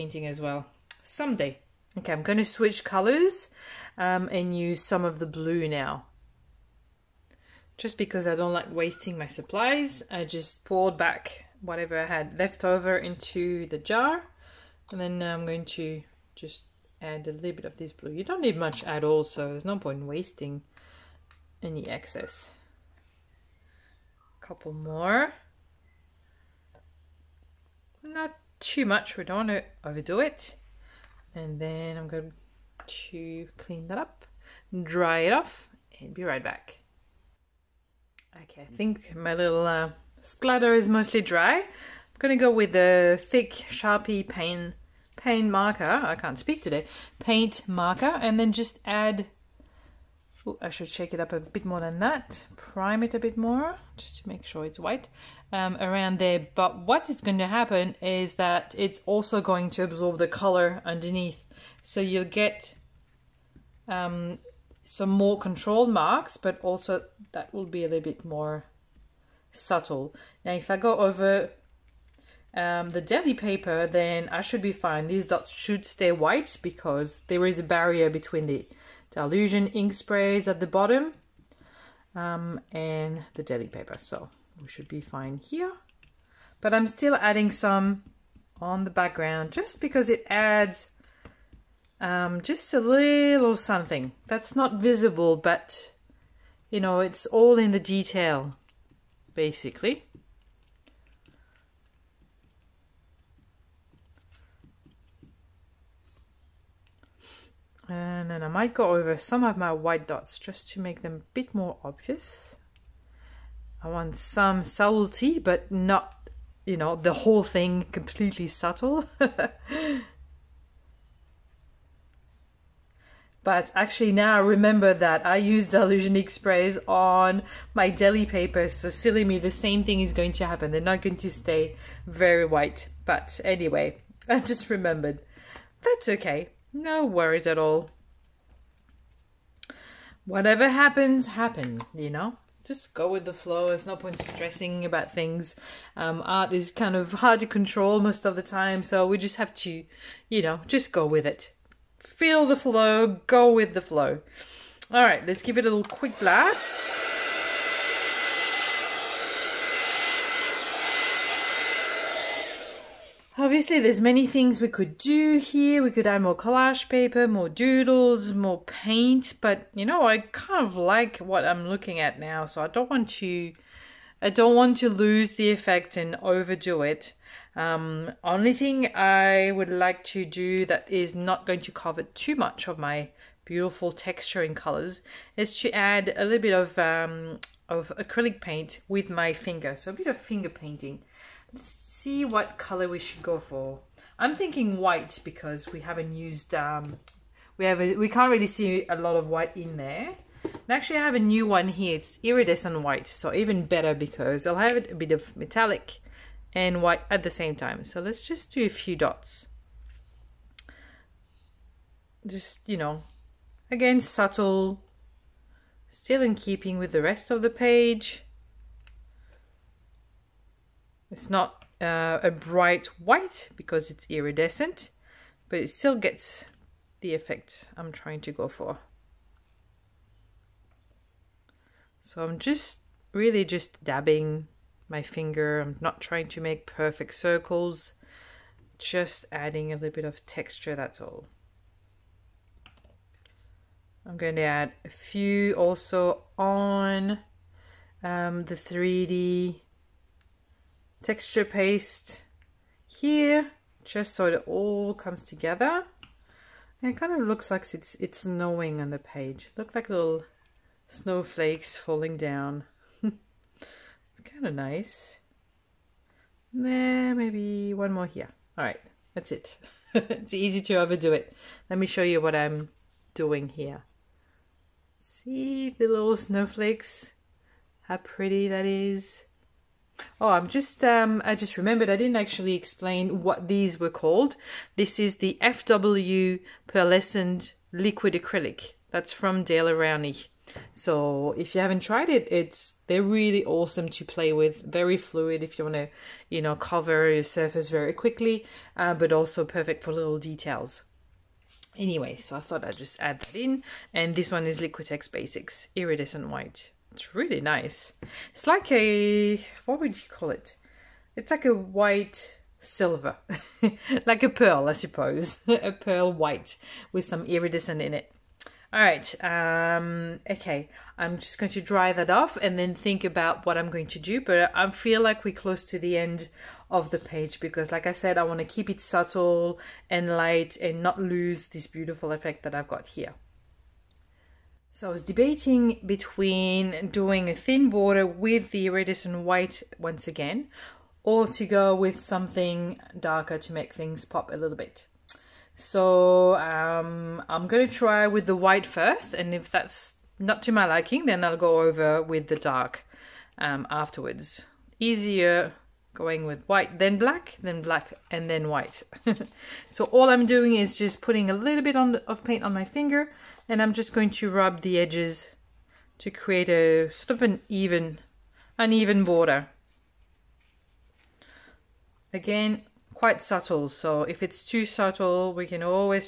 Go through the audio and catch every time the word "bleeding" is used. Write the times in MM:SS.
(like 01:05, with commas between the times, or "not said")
not said.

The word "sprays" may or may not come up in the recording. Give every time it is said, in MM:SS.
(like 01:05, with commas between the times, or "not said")
01:19, 02:06.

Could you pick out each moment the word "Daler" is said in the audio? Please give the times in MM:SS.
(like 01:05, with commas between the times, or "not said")
04:49.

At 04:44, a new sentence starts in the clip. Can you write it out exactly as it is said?
This is the FW pearlescent liquid acrylic.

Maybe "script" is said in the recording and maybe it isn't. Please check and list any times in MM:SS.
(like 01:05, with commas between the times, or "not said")
not said.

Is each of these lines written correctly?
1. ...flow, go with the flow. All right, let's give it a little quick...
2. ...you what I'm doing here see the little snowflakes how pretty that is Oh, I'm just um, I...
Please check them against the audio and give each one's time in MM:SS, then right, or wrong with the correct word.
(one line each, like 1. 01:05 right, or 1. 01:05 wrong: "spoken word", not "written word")
1. 02:32 right
2. 04:32 right.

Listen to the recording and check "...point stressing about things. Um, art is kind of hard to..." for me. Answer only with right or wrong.
right.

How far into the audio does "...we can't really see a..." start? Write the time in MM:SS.
03:17.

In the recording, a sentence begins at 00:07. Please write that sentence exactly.
Just because I don't like wasting my supplies, I just poured back whatever I had left over into the jar.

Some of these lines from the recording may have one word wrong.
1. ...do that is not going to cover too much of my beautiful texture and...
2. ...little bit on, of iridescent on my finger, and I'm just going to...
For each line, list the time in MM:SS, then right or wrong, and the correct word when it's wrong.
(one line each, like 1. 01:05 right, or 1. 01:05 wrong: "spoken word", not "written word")
1. 03:00 right
2. 06:01 wrong: "paint", not "iridescent".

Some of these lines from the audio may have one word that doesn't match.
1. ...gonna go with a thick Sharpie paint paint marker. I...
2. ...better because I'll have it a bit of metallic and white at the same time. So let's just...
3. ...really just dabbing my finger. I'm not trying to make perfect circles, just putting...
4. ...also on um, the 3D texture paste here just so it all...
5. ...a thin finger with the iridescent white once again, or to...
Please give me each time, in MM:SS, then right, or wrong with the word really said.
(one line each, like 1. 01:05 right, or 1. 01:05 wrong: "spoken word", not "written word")
1. 00:42 right
2. 03:23 right
3. 03:53 wrong: "adding", not "putting"
4. 04:05 right
5. 05:37 wrong: "border", not "finger".